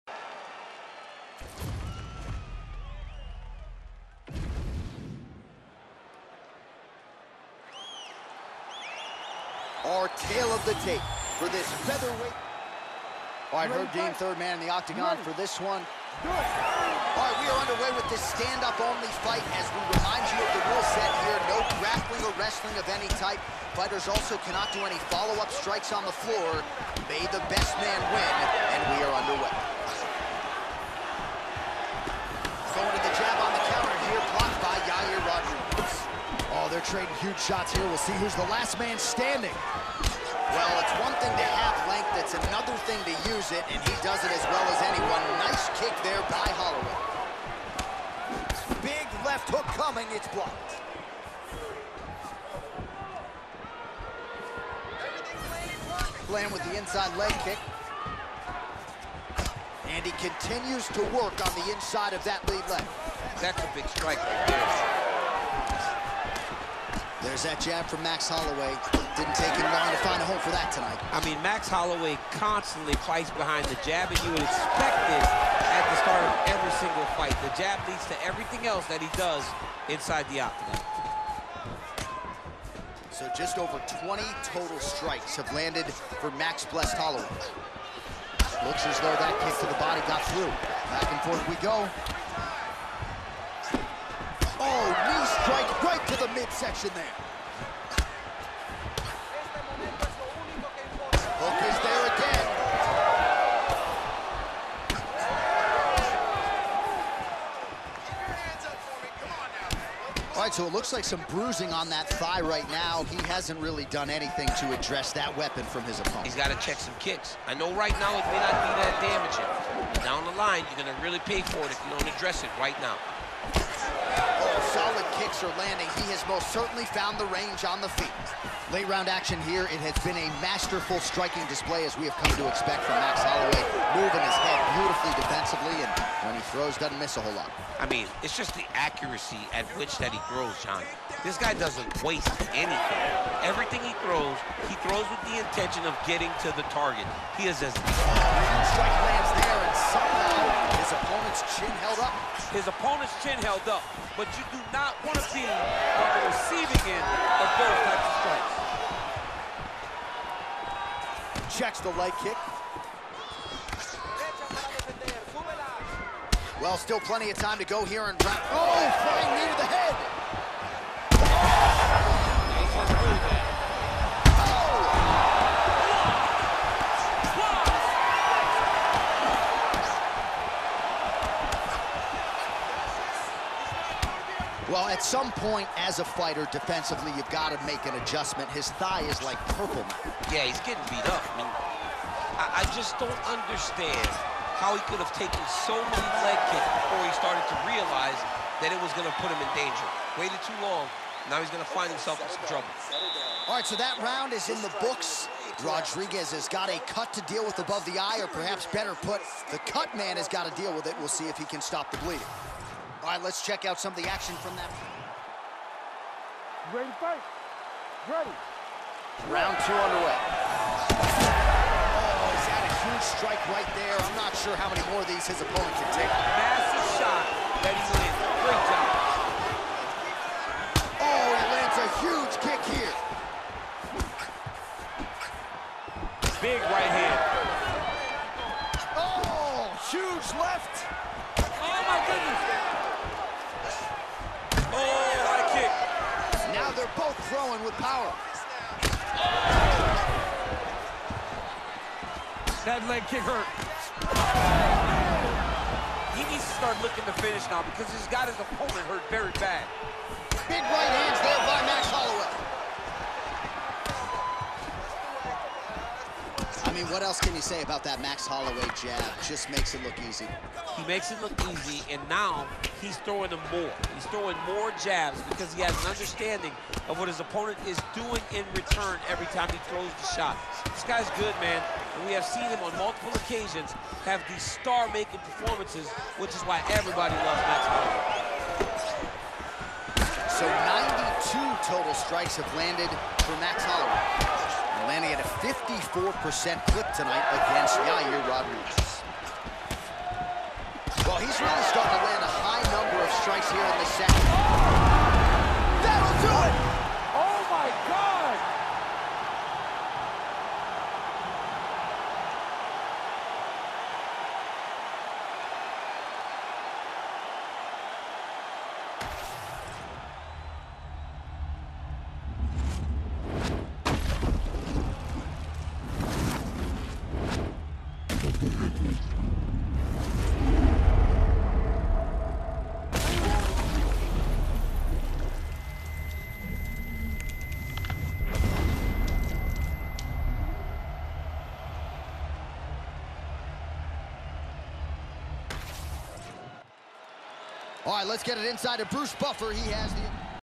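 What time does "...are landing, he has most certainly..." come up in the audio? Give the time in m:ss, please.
2:05.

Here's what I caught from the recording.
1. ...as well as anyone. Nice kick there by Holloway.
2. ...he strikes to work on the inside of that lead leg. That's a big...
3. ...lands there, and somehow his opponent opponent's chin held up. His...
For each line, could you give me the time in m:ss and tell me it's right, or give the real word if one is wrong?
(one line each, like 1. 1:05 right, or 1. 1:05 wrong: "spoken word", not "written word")
1. 0:44 right
2. 1:00 wrong: "continues", not "strikes"
3. 2:29 right.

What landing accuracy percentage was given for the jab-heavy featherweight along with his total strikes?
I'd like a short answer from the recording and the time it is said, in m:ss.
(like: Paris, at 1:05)
54%, at 4:55.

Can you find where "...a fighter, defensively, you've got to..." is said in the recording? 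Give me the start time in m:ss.
3:05.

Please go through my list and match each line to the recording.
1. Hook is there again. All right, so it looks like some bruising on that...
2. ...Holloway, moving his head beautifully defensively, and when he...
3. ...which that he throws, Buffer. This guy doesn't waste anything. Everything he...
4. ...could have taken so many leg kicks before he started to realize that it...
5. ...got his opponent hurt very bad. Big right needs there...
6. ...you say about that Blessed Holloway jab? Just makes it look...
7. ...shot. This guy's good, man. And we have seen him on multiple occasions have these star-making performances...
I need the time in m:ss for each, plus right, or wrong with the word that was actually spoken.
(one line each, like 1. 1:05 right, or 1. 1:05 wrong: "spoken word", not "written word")
1. 1:41 right
2. 2:13 right
3. 2:19 wrong: "John", not "Buffer"
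4. 3:14 right
5. 4:18 wrong: "hands", not "needs"
6. 4:27 wrong: "Max", not "Blessed"
7. 4:40 right.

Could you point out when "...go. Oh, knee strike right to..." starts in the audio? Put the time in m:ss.
1:31.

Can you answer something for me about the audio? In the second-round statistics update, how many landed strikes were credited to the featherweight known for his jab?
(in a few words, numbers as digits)
92.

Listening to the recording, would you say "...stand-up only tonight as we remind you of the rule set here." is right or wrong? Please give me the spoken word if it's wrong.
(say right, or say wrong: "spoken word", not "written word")
wrong: "fight", not "tonight".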